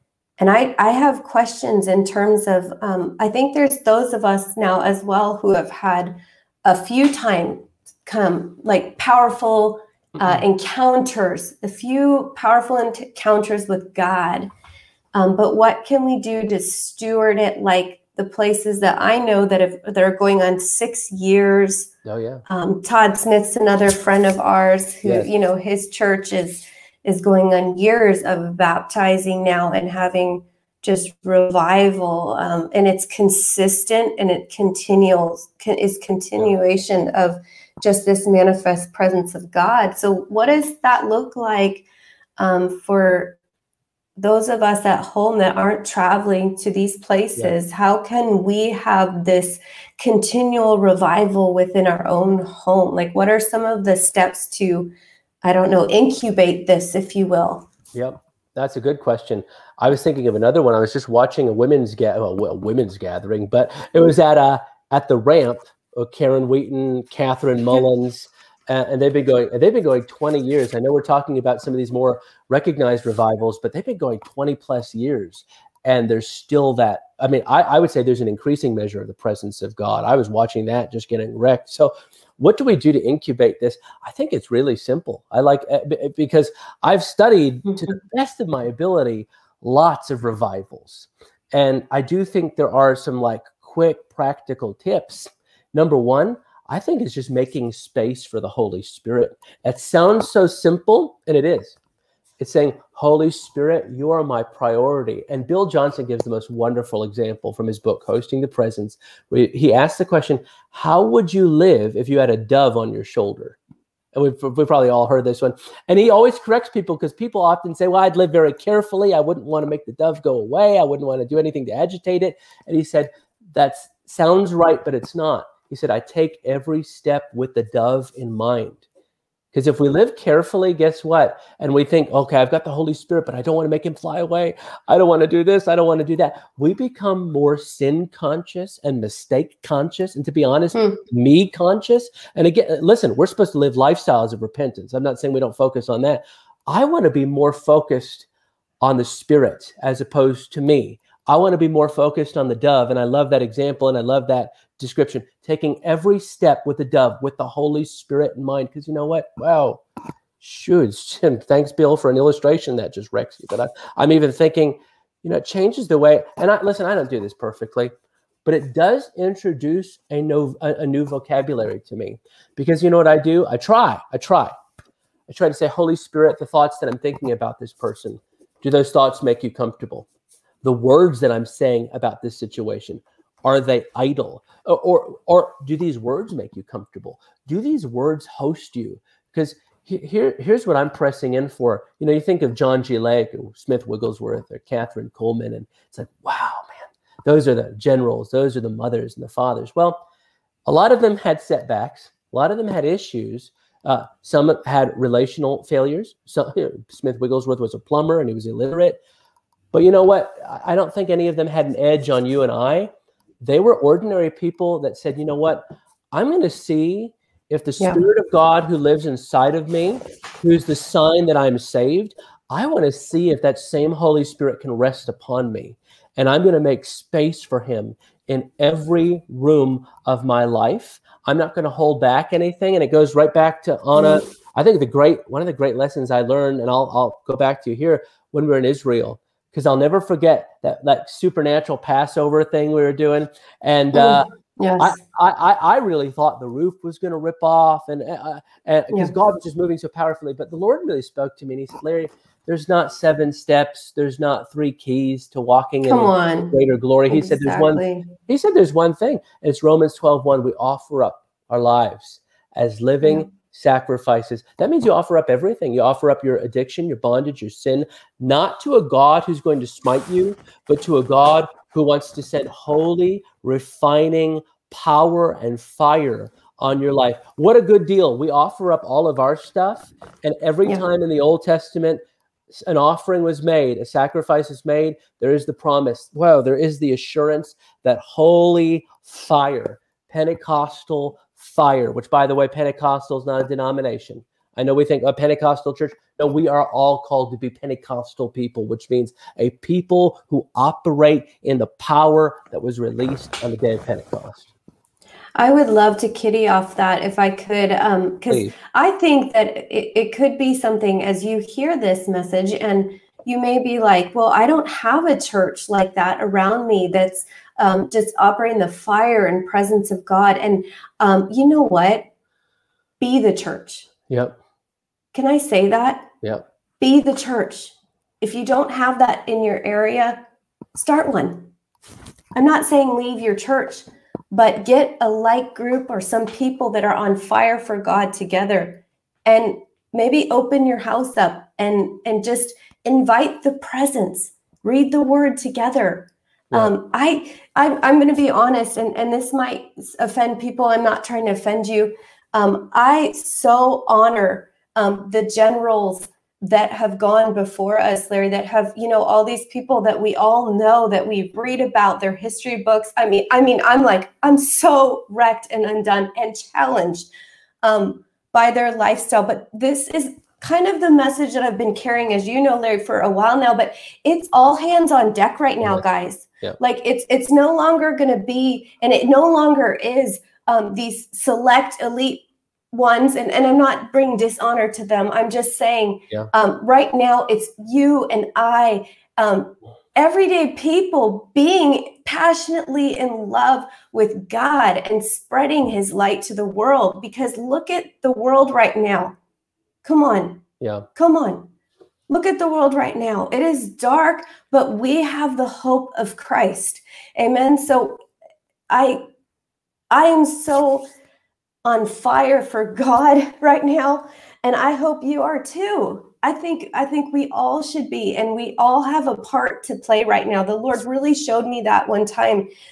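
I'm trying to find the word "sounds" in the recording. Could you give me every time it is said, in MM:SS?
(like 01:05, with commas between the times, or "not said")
01:39, 02:04.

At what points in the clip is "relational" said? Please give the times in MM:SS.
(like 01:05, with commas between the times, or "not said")
03:24.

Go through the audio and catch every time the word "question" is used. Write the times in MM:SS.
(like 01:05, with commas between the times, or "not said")
00:01, 00:58, 01:50.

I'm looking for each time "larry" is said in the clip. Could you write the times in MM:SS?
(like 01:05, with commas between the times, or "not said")
04:11, 05:58, 06:12.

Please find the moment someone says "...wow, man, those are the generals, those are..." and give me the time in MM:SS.
03:16.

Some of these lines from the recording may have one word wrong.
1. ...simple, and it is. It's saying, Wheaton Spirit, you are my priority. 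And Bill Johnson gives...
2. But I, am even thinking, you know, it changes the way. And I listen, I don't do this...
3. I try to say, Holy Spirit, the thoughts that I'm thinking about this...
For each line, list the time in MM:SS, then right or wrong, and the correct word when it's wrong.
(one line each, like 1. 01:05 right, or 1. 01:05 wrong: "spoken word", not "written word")
1. 01:40 wrong: "Holy", not "Wheaton"
2. 02:43 right
3. 02:54 right.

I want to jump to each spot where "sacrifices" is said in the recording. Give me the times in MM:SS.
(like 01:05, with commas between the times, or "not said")
04:23, 04:43.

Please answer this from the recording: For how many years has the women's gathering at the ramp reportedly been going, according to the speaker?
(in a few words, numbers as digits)
20 plus years.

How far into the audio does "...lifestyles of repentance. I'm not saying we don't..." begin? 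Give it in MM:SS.
02:23.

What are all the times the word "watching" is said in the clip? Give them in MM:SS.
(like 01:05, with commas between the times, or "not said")
01:01, 01:20.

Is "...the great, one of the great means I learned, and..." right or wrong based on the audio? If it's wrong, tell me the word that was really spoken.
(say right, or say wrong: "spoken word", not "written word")
wrong: "lessons", not "means".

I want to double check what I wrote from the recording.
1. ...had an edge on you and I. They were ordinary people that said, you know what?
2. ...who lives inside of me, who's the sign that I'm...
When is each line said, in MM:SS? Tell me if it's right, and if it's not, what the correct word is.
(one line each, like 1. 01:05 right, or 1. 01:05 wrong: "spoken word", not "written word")
1. 03:31 right
2. 03:38 right.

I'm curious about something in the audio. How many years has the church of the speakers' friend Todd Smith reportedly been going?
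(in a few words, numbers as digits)
6 years.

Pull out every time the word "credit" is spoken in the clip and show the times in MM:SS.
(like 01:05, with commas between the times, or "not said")
not said.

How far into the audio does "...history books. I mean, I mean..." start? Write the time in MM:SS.
06:02.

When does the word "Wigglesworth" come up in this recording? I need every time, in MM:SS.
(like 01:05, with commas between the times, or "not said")
03:13, 03:27.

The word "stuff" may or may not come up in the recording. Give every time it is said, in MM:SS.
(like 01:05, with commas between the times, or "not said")
04:39.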